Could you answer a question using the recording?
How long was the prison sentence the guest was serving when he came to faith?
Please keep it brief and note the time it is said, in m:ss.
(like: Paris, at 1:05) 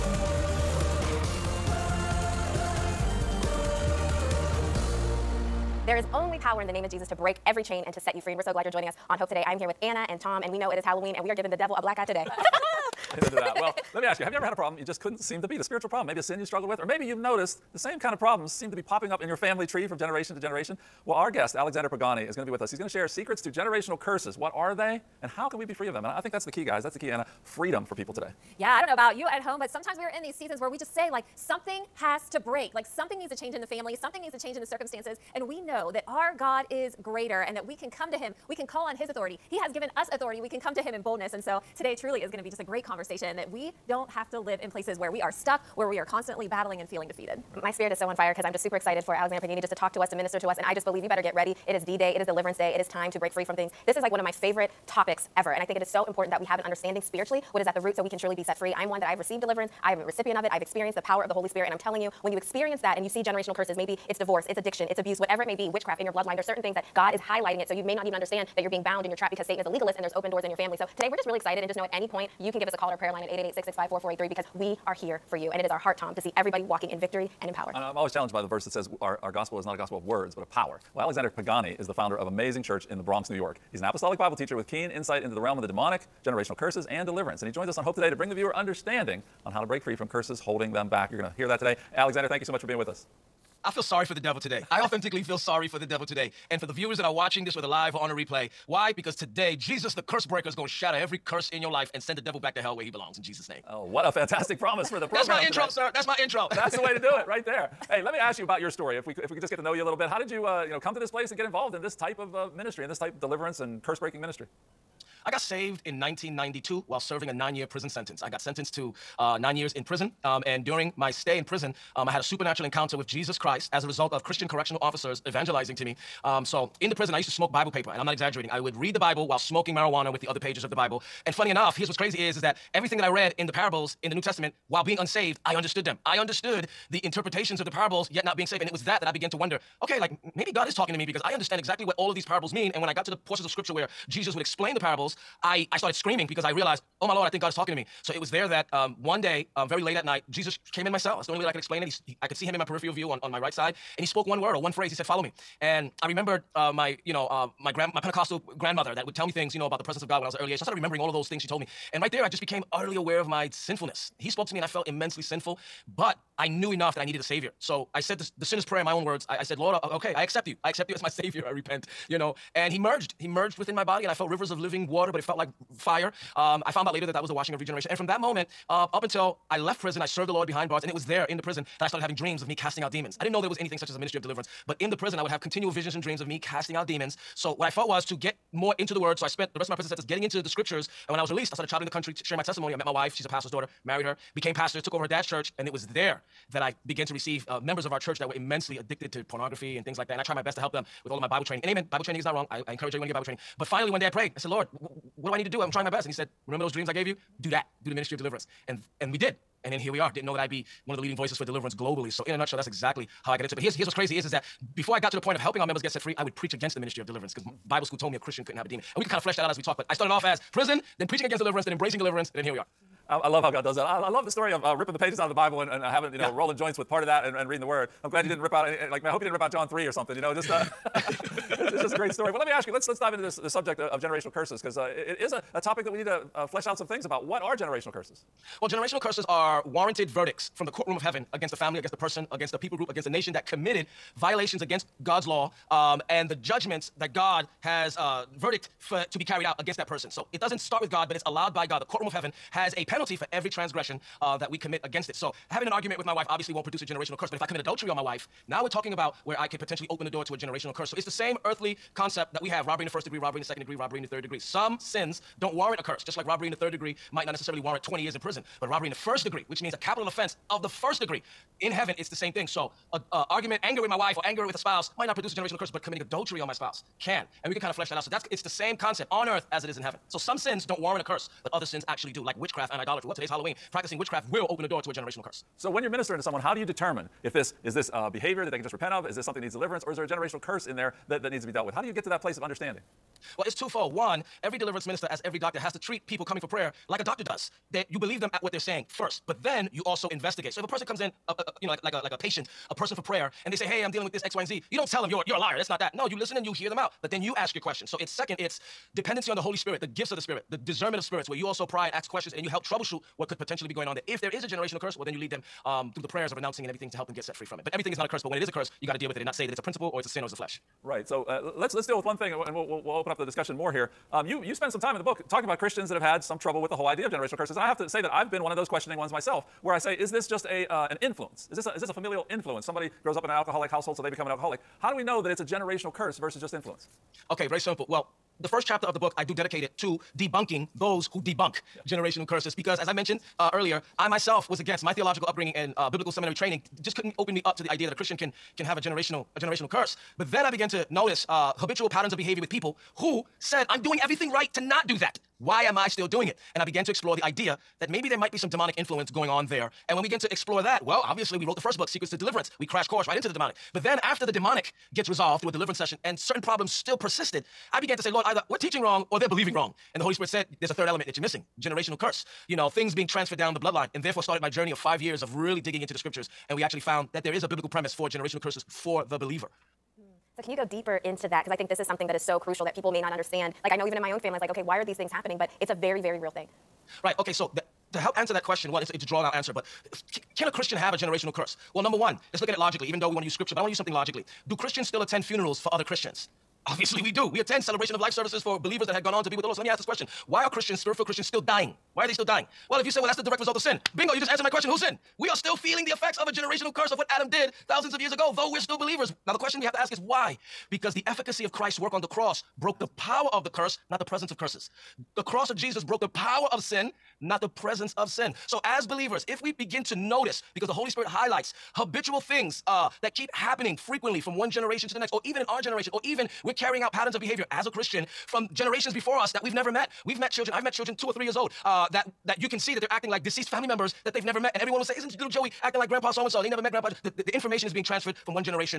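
9 years, at 1:57.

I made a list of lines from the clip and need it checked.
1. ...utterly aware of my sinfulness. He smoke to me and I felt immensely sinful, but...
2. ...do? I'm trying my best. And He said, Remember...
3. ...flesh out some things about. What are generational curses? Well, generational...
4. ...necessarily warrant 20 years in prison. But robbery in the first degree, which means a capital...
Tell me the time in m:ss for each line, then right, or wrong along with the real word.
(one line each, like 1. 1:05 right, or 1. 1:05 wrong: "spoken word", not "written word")
1. 2:42 wrong: "spoke", not "smoke"
2. 3:25 right
3. 3:56 right
4. 4:27 right.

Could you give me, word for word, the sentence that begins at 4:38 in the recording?
So that's it's the same concept on earth as it is in heaven.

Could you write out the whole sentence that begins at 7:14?
And everyone would say, Isn't little Joey acting like Grandpa so and so?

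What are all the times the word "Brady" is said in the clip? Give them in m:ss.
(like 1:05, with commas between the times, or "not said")
not said.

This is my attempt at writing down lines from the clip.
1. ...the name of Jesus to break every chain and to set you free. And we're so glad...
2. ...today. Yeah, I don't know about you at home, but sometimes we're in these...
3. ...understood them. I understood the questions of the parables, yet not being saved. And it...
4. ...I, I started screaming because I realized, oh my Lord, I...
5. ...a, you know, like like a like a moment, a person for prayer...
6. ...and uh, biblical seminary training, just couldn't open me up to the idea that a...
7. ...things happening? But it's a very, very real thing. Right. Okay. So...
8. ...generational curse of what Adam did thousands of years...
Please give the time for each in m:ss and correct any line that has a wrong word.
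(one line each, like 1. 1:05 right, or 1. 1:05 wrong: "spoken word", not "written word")
1. 0:06 right
2. 0:28 right
3. 2:15 wrong: "interpretations", not "questions"
4. 2:25 right
5. 5:01 wrong: "patient", not "moment"
6. 5:45 right
7. 6:24 right
8. 6:46 right.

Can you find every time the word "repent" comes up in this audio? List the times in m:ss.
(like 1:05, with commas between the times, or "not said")
2:51, 4:48.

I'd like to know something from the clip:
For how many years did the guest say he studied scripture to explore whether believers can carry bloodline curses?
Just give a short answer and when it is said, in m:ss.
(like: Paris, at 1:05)
5, at 6:14.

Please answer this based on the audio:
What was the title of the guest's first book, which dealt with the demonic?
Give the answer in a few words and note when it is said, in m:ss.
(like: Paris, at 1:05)
Secrets to Deliverance, at 6:01.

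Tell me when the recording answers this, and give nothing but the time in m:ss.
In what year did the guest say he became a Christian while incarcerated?
1:55.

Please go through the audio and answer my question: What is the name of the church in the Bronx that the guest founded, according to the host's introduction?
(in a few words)
Amazing Church.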